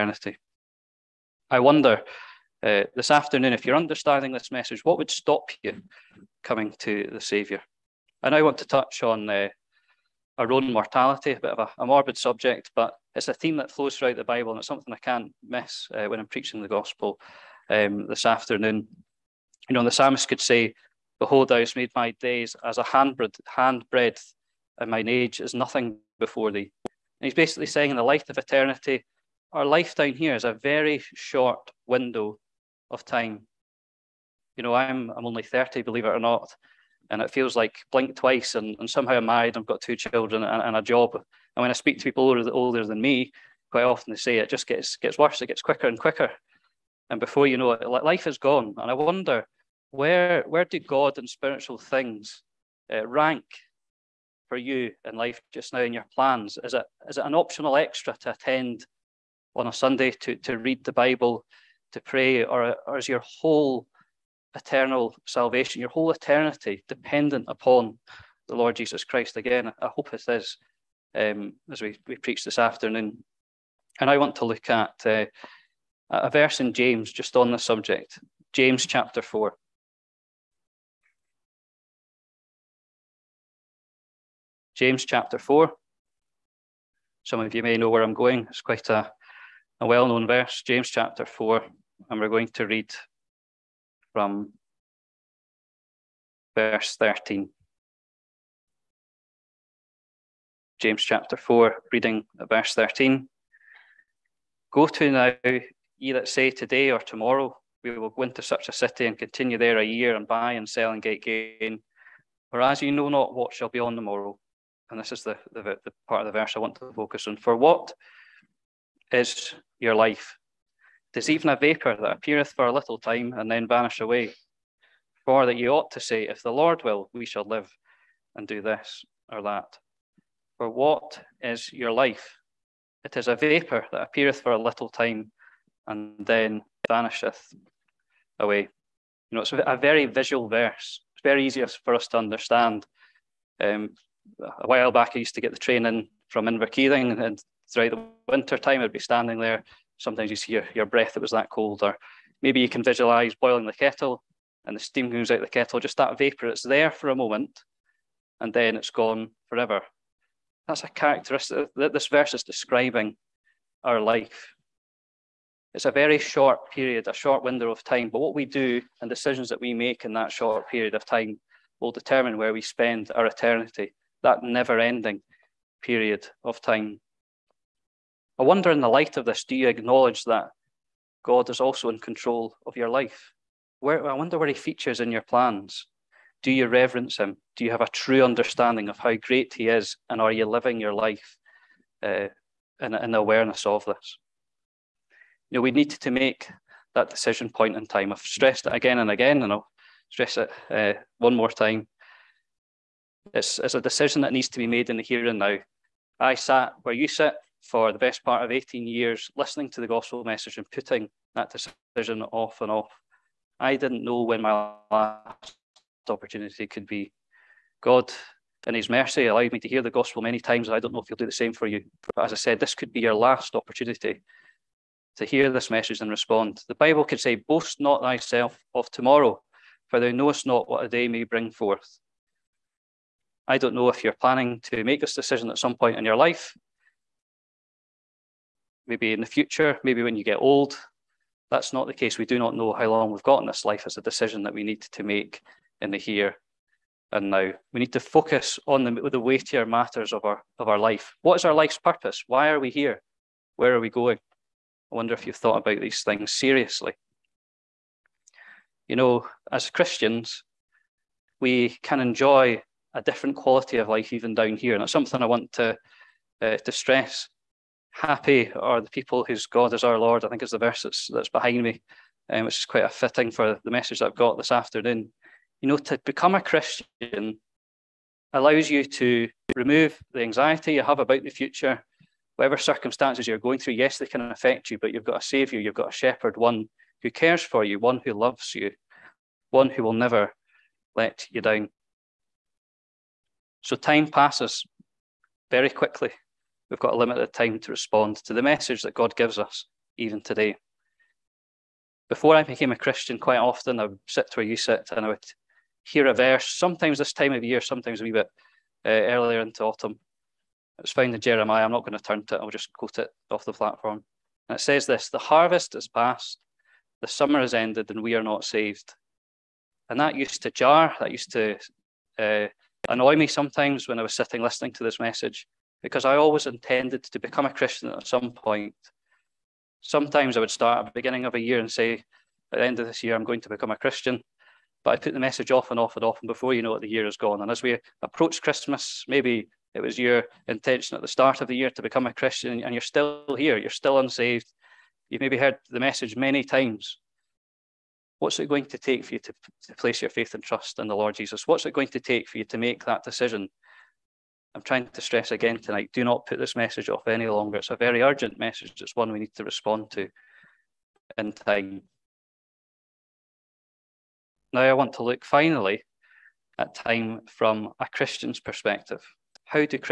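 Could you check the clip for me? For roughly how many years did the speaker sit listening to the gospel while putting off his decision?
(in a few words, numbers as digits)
18 years.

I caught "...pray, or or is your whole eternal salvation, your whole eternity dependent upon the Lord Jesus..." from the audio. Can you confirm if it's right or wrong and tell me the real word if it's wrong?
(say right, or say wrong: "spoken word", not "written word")
right.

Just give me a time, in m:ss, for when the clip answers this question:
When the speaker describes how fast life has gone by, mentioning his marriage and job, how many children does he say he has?
0:39.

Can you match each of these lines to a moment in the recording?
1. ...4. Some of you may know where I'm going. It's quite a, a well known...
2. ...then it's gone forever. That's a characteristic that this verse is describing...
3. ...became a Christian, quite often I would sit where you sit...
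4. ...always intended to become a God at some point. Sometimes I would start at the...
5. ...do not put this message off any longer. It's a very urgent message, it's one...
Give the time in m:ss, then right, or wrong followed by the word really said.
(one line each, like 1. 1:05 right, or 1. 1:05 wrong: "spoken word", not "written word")
1. 1:25 right
2. 2:38 right
3. 5:02 right
4. 5:26 wrong: "Christian", not "God"
5. 5:55 right.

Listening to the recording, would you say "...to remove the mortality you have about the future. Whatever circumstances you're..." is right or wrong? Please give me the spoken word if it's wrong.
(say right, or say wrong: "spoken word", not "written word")
wrong: "anxiety", not "mortality".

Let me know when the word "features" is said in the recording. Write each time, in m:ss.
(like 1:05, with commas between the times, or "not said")
3:04.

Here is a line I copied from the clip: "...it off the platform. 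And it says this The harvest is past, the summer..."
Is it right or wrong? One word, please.
right.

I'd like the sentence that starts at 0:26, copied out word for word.
And he's basically saying, in the light of eternity, our life down here is a very short window of time.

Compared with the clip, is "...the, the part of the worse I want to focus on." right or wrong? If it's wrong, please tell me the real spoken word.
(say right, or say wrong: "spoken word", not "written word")
wrong: "verse", not "worse".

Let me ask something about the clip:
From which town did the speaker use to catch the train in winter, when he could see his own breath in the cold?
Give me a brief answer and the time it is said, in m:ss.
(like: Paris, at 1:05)
Inverkeithing, at 2:26.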